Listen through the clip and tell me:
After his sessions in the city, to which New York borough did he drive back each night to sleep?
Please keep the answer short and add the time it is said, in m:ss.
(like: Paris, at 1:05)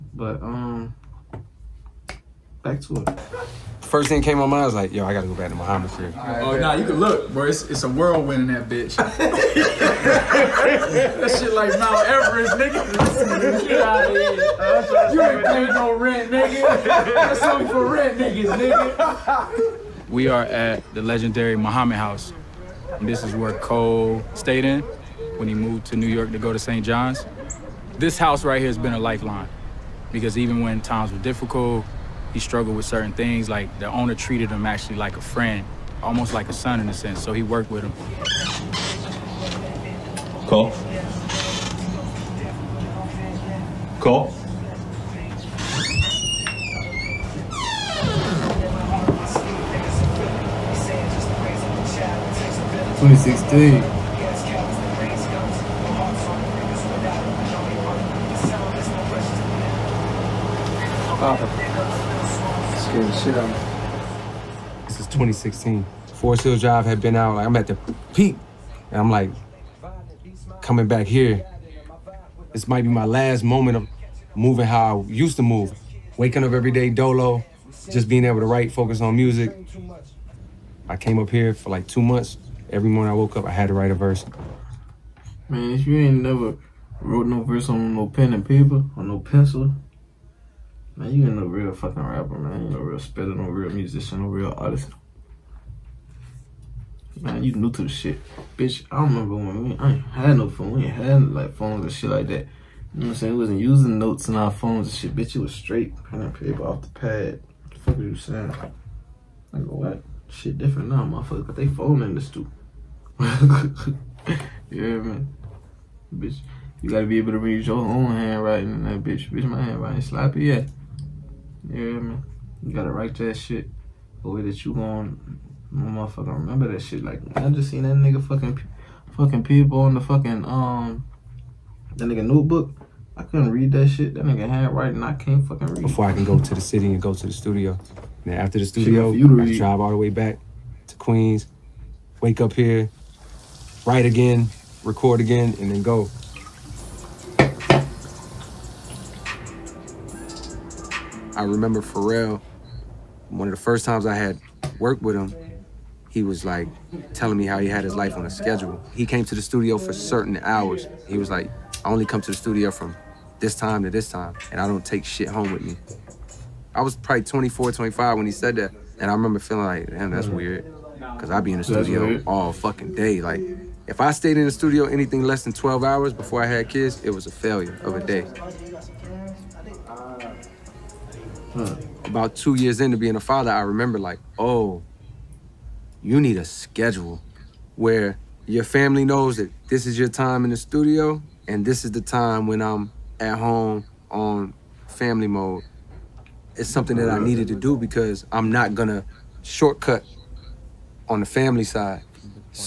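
Queens, at 2:20.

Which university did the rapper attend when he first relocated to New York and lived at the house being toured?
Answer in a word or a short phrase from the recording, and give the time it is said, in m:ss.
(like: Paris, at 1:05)
St. John's, at 0:26.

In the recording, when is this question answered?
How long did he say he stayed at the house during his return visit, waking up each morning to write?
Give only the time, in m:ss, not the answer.
1:21.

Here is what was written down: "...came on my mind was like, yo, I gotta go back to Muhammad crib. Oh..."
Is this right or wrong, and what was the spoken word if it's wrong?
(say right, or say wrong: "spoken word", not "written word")
right.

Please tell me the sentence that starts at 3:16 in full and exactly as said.
It's something that I needed to do because I'm not gonna shortcut on the family side.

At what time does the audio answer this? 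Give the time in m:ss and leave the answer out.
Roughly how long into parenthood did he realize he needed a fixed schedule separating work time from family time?
3:02.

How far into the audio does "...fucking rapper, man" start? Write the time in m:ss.
1:31.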